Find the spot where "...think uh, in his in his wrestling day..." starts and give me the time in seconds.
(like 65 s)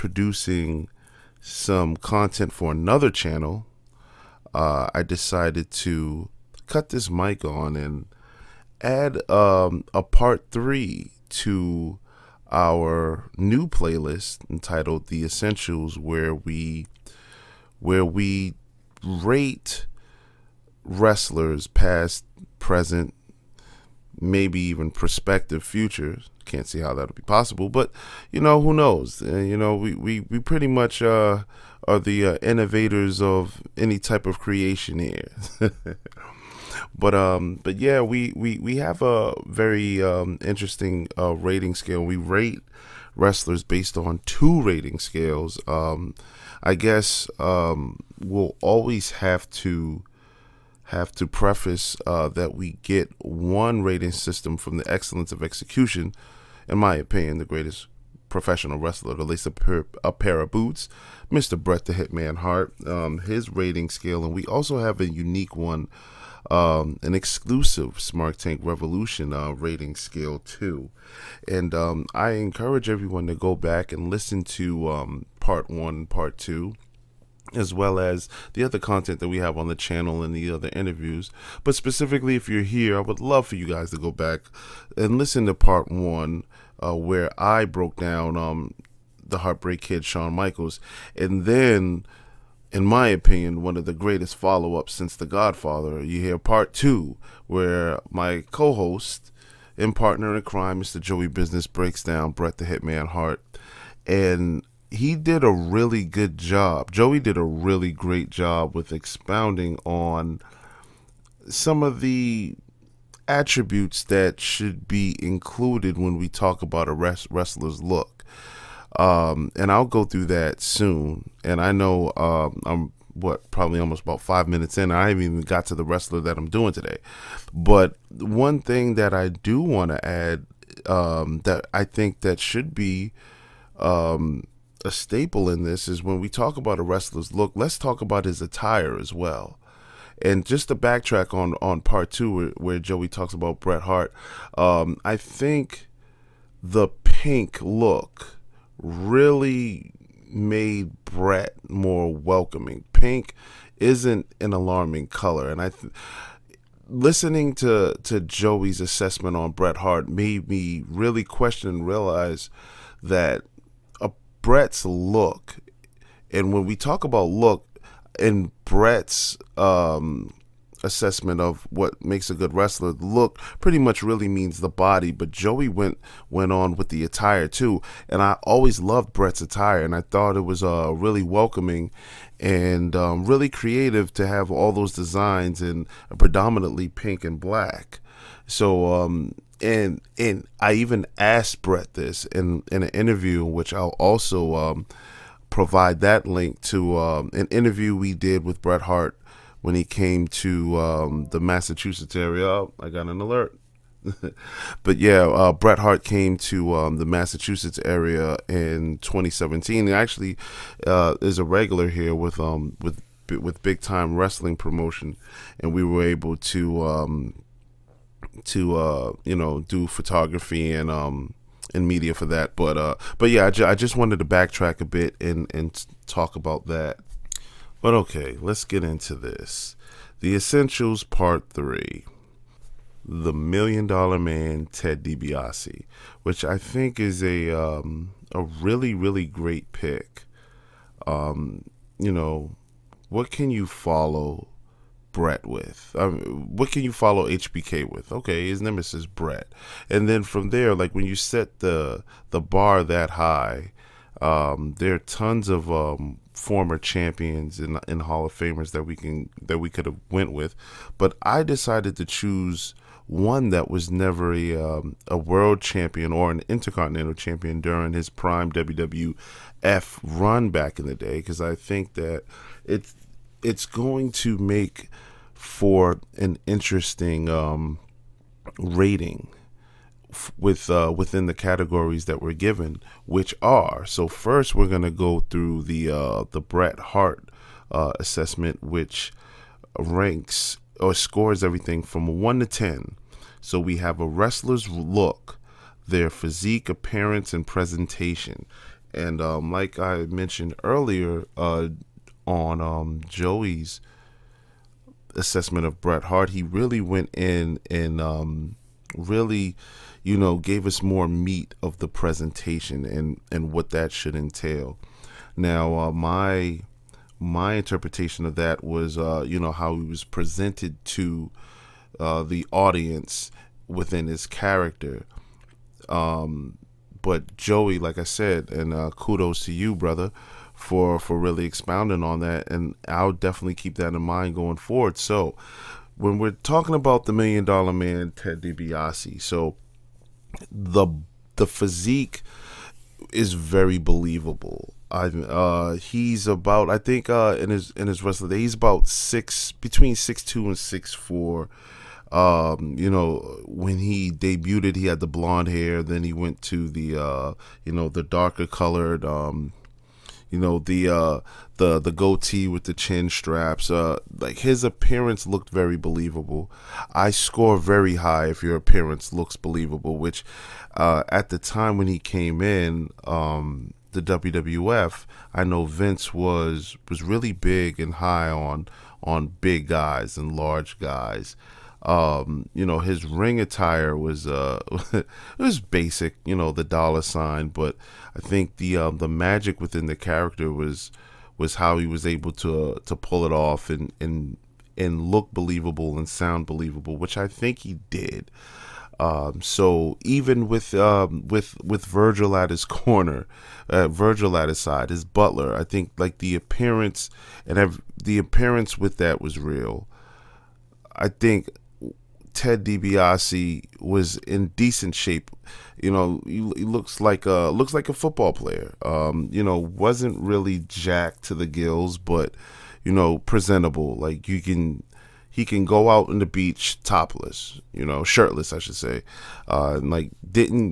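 346 s.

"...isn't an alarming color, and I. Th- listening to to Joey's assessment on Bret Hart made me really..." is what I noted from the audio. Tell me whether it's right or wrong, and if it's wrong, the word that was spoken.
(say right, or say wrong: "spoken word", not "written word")
right.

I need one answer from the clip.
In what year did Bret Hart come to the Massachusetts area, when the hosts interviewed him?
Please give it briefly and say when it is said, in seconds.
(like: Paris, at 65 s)
2017, at 208 s.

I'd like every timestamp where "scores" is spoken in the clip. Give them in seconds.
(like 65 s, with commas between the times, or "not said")
290 s, 367 s.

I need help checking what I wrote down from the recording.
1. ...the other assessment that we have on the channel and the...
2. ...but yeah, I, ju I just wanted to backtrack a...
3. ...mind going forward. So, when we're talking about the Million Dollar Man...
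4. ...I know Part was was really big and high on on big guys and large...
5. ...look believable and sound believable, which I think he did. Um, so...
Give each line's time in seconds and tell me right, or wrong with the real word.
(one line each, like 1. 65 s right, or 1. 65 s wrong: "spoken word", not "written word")
1. 78 s wrong: "content", not "assessment"
2. 223 s right
3. 334 s right
4. 375 s wrong: "Vince", not "Part"
5. 395 s right.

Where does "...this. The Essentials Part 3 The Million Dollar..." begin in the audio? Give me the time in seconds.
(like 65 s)
229 s.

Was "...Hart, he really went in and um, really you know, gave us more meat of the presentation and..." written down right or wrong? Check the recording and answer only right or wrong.
right.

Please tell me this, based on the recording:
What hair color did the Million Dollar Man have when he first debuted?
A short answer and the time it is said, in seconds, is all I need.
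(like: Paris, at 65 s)
Blonde, at 355 s.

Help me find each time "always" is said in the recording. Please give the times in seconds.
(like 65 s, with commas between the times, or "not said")
48 s, 178 s.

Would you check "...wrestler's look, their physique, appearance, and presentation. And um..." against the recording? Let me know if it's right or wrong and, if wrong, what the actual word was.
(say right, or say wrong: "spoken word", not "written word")
right.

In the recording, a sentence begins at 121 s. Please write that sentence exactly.
And I know uh, I'm what probably almost about five minutes in.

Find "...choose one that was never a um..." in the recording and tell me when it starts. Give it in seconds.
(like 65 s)
262 s.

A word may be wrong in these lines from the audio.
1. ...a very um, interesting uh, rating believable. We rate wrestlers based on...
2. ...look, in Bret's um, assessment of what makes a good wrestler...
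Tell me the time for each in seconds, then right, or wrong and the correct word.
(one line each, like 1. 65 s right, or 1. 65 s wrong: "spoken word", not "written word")
1. 39 s wrong: "scale", not "believable"
2. 167 s right.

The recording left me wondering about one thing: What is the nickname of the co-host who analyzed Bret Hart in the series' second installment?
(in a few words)
Joey Business.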